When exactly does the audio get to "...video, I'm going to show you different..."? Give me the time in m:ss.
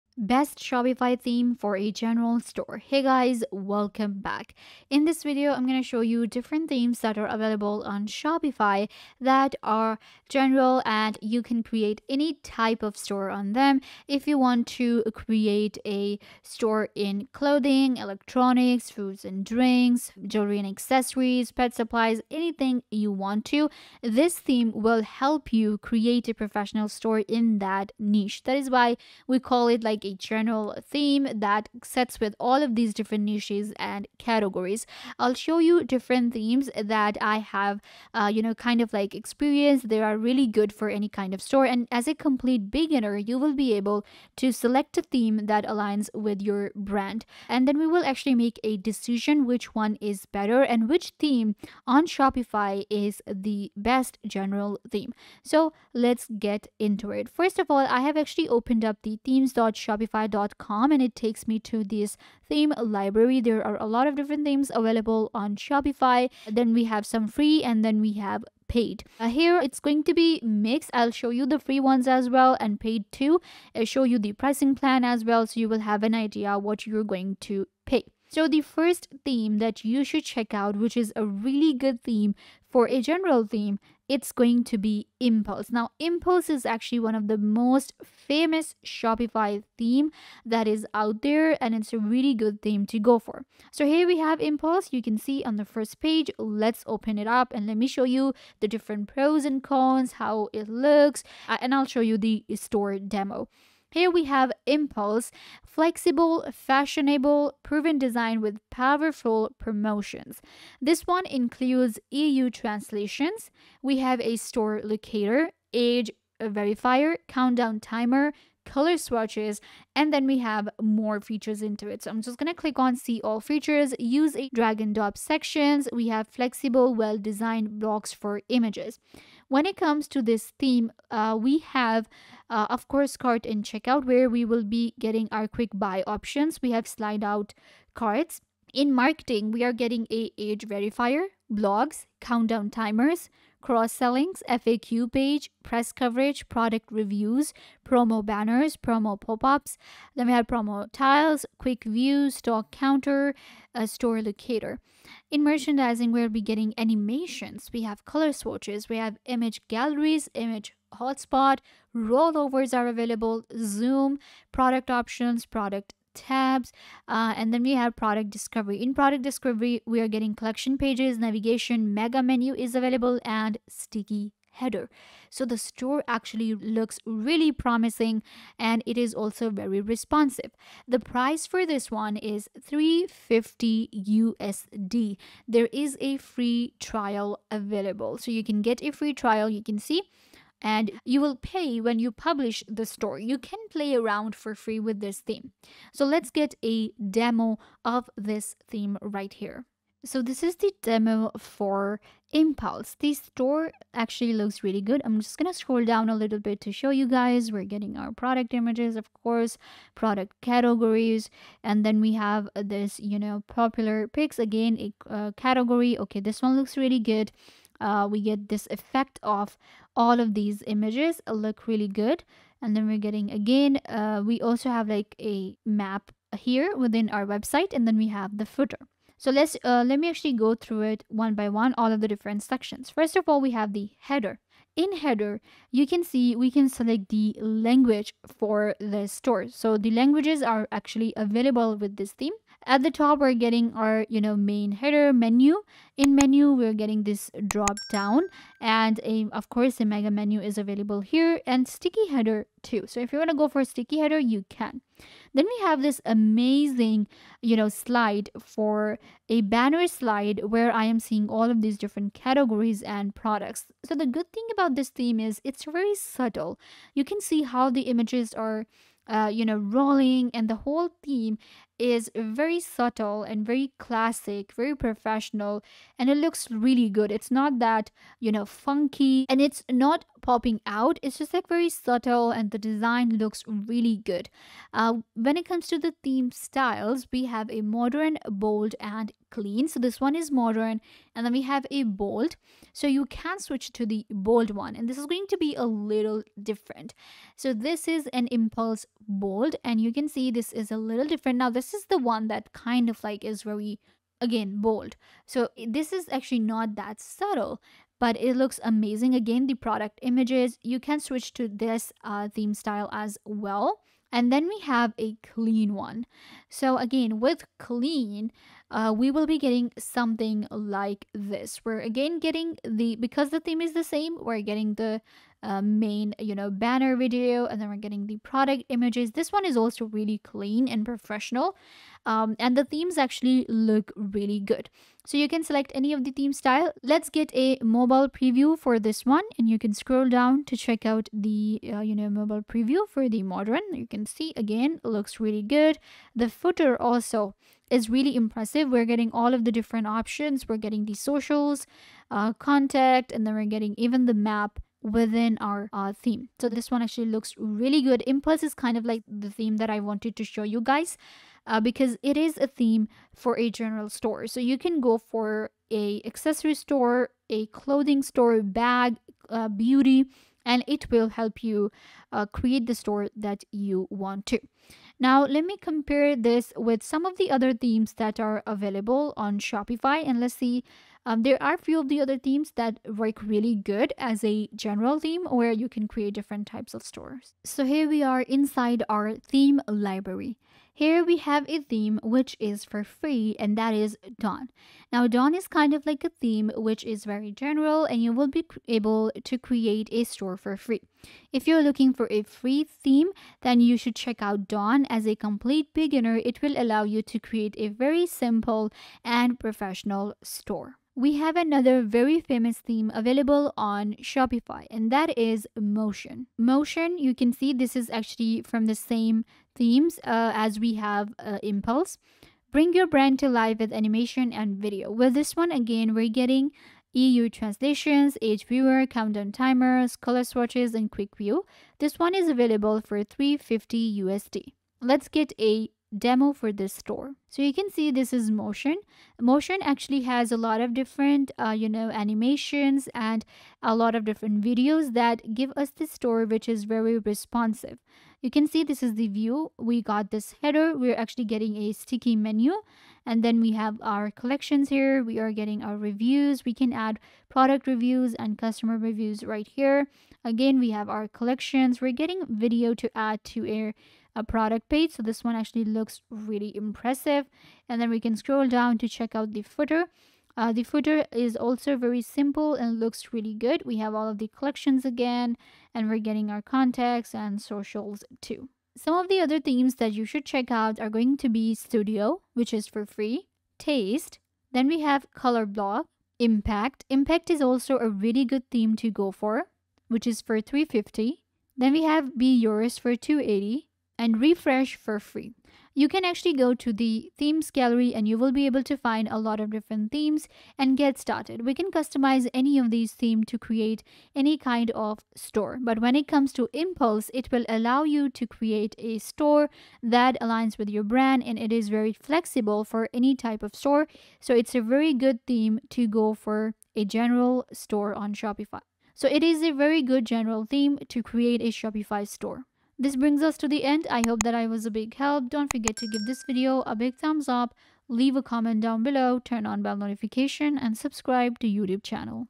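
0:05.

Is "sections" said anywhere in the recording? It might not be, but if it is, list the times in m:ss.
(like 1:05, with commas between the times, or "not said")
2:05, 3:52.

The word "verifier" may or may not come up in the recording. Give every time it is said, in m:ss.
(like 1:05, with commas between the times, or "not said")
1:56, 2:20.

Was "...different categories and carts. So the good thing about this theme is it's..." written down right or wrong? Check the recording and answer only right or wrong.
wrong.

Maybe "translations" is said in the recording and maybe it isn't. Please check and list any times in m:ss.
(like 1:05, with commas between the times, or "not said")
1:52, 7:07.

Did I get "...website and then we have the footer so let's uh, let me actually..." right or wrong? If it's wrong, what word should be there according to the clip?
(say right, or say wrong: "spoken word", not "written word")
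right.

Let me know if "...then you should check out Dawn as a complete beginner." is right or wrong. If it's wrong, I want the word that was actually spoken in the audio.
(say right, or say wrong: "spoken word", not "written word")
right.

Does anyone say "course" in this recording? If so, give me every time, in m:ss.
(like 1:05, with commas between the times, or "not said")
2:12, 3:29, 4:09.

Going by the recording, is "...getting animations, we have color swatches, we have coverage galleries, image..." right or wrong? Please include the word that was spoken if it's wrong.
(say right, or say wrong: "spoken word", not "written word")
wrong: "image", not "coverage".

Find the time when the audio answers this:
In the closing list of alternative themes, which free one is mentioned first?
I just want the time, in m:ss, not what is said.
8:01.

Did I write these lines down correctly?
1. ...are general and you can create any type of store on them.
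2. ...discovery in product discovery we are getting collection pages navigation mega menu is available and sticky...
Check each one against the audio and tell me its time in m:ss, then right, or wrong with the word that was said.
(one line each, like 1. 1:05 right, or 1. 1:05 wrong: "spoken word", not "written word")
1. 0:09 right
2. 2:48 right.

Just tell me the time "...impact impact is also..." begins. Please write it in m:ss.
8:06.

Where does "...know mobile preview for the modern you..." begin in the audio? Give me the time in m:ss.
5:41.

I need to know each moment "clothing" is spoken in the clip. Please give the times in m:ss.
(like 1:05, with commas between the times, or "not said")
0:17, 6:07.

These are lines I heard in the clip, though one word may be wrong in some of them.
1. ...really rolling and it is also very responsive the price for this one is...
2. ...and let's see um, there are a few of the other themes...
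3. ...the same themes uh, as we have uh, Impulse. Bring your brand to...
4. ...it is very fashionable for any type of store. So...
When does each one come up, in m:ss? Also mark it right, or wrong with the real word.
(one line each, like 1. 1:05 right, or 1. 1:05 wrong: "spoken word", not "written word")
1. 2:57 wrong: "promising", not "rolling"
2. 6:20 right
3. 6:58 right
4. 8:31 wrong: "flexible", not "fashionable".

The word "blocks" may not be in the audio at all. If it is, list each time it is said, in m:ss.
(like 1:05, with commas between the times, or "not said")
2:07, 8:05.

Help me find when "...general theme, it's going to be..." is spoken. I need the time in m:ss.
1:23.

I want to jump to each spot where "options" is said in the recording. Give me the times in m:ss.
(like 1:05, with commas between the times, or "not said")
2:16, 2:44, 5:49.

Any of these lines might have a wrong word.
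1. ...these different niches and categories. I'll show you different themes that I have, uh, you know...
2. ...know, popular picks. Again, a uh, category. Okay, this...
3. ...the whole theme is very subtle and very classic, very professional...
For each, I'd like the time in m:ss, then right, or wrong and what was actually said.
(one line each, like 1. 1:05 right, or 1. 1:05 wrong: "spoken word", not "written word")
1. 0:32 right
2. 3:33 right
3. 4:30 right.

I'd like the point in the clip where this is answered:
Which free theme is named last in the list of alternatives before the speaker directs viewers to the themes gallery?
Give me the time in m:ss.
8:14.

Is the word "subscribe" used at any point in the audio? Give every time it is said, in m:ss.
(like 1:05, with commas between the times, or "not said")
8:50.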